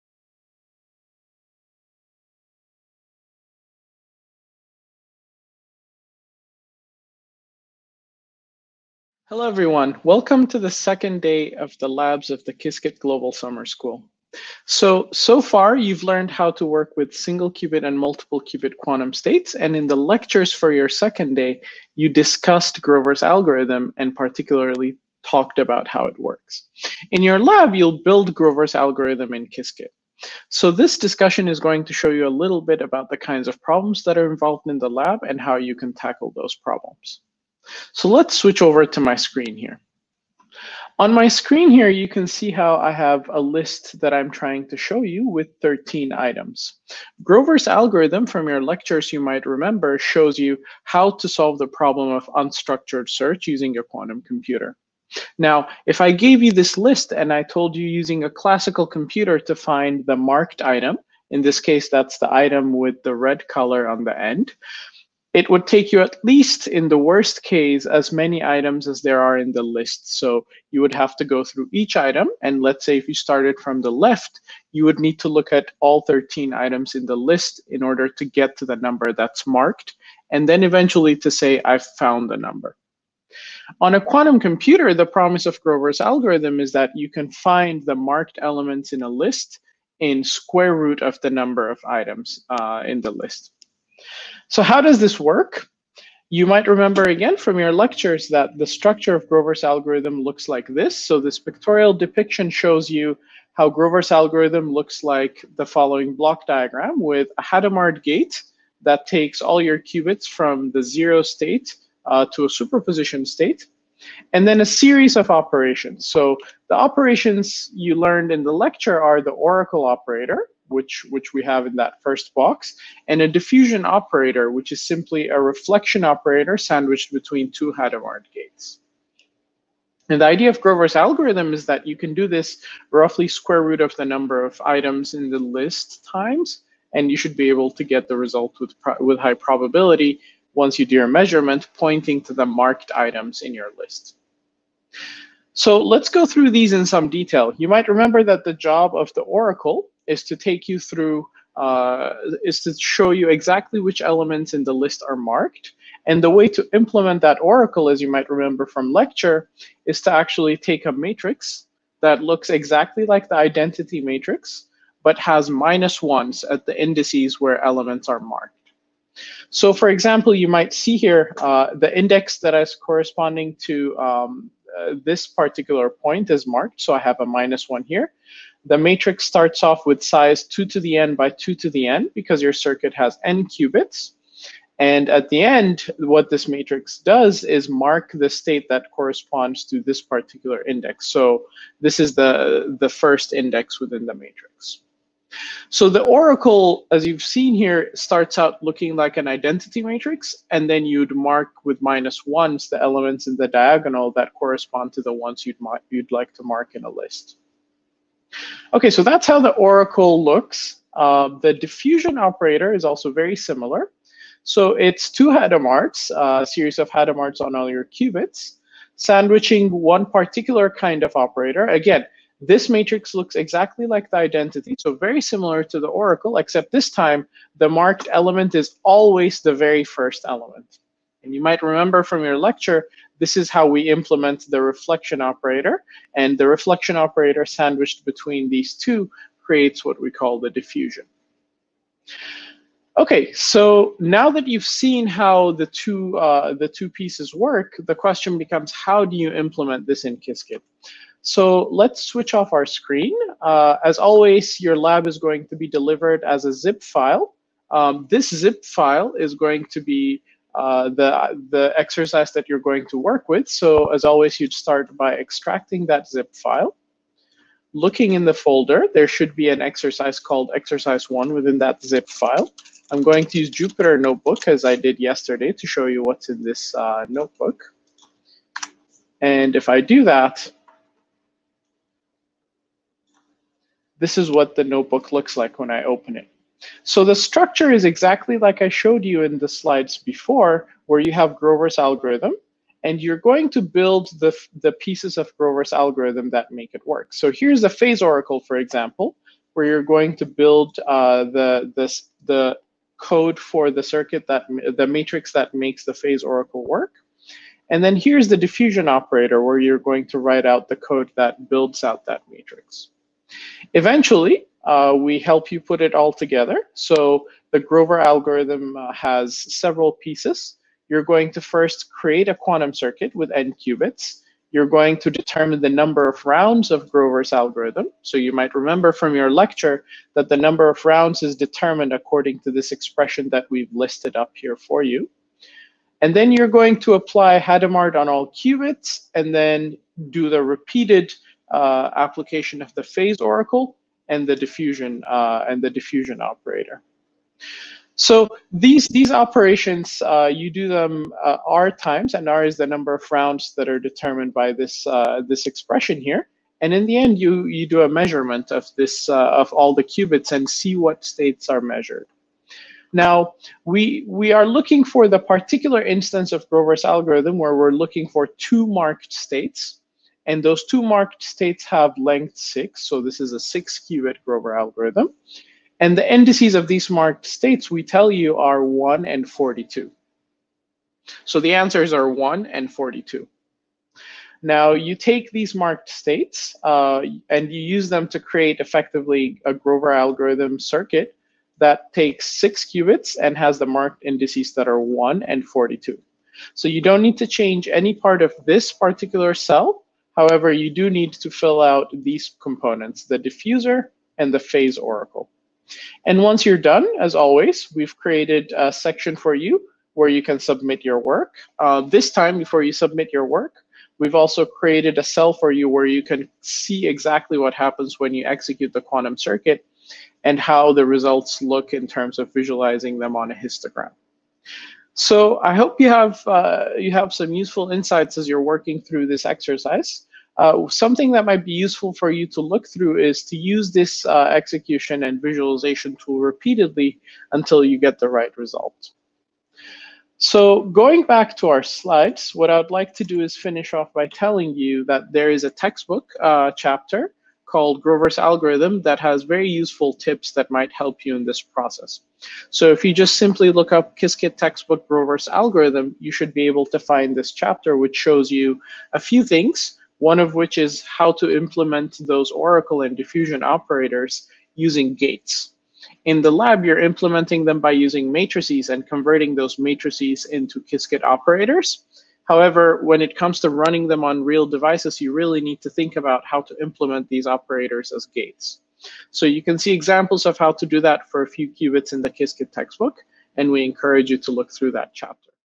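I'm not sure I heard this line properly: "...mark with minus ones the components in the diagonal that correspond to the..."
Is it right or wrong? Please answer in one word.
wrong.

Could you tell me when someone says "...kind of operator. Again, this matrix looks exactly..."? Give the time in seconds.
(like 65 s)
220 s.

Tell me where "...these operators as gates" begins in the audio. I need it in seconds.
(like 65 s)
477 s.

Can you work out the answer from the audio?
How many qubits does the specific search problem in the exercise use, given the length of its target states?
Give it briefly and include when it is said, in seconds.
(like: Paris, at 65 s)
6, at 373 s.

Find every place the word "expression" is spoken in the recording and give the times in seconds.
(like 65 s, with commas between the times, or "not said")
332 s, 355 s.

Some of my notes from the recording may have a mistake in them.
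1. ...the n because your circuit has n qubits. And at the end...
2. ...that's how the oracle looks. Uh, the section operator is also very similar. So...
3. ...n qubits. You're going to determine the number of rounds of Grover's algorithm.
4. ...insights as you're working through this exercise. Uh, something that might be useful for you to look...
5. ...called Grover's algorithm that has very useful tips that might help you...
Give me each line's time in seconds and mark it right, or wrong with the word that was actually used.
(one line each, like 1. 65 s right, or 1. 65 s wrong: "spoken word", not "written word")
1. 181 s right
2. 209 s wrong: "diffusion", not "section"
3. 323 s right
4. 427 s right
5. 447 s right.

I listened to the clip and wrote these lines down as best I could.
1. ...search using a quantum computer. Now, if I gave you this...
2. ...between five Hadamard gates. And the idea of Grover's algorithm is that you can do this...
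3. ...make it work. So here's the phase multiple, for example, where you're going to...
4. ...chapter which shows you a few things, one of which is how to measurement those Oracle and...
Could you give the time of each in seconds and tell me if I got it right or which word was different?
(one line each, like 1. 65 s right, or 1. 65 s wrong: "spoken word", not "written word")
1. 53 s right
2. 127 s wrong: "two", not "five"
3. 296 s wrong: "oracle", not "multiple"
4. 457 s wrong: "implement", not "measurement".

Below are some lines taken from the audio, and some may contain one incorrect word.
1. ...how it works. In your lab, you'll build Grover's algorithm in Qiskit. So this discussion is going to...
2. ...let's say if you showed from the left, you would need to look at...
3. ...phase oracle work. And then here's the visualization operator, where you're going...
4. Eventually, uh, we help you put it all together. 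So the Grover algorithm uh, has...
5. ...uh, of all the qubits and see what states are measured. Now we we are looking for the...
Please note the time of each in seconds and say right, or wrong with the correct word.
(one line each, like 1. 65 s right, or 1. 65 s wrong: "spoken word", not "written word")
1. 25 s right
2. 72 s wrong: "started", not "showed"
3. 305 s wrong: "diffusion", not "visualization"
4. 313 s right
5. 359 s right.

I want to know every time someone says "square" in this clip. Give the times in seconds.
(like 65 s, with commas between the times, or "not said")
90 s, 133 s.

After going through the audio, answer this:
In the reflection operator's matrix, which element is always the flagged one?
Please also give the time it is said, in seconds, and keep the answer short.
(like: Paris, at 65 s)
the very first element, at 229 s.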